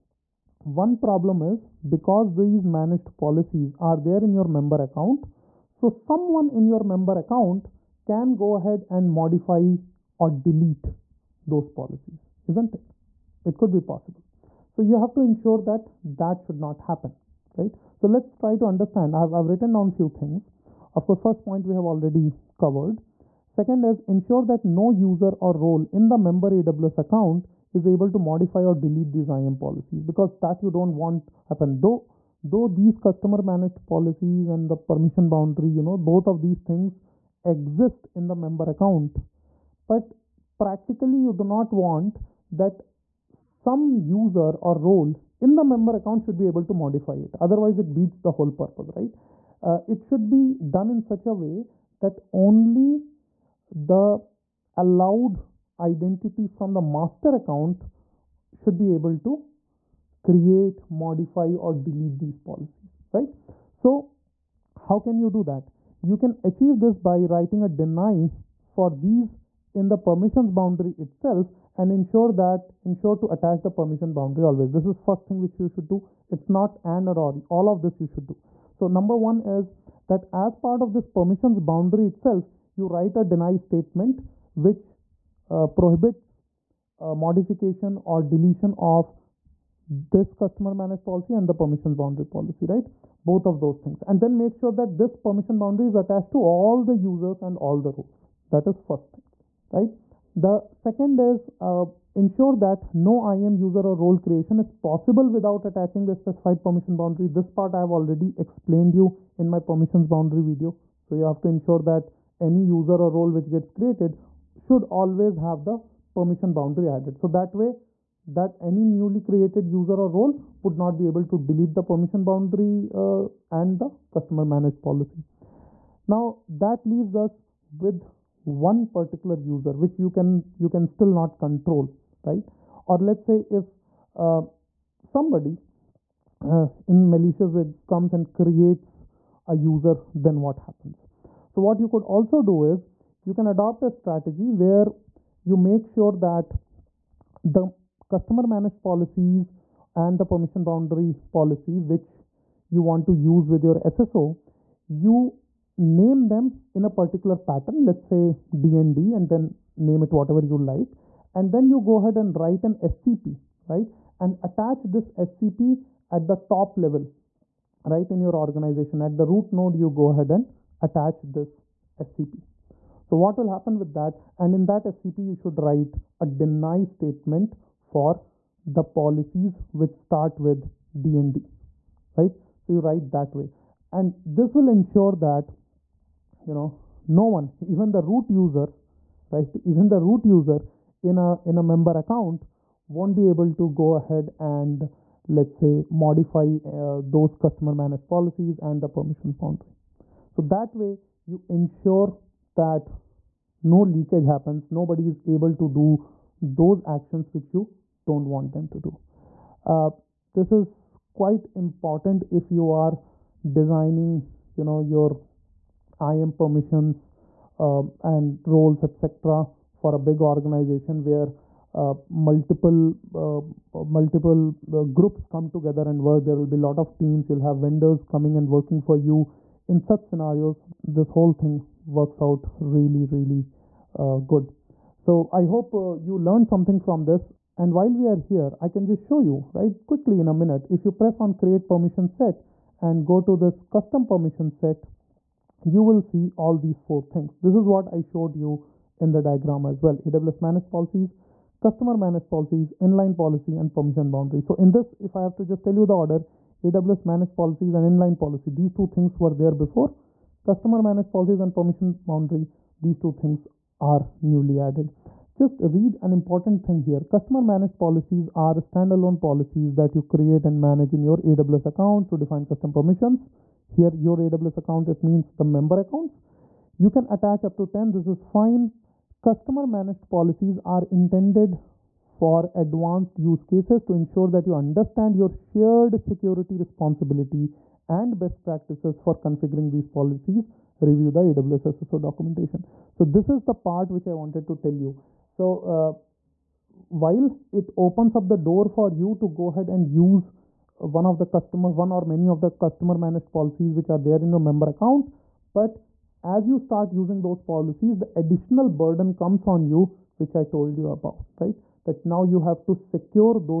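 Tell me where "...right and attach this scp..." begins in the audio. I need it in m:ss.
2:43.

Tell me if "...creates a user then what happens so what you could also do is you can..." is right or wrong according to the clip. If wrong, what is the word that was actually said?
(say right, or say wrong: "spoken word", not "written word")
right.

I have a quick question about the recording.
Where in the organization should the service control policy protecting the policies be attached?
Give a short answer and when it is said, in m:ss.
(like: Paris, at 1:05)
root node, at 2:49.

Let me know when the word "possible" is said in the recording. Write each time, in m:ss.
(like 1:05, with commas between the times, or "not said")
0:13, 1:44.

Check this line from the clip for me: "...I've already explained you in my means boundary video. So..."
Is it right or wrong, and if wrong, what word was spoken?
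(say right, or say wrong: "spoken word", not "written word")
wrong: "permissions", not "means".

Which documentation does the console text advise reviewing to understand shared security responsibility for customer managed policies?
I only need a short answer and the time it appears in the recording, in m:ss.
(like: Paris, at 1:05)
AWS SSO documentation, at 4:51.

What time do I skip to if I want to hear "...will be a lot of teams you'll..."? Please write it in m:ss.
3:46.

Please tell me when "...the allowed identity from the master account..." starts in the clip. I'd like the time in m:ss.
0:53.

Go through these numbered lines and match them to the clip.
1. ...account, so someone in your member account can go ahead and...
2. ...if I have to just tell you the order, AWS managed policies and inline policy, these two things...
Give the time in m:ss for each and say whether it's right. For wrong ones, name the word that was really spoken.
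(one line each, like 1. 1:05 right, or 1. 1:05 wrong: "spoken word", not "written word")
1. 0:04 right
2. 4:14 right.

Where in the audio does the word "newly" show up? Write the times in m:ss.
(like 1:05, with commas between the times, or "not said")
1:58, 4:24.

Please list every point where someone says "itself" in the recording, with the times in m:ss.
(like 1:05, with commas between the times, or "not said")
1:10, 1:22.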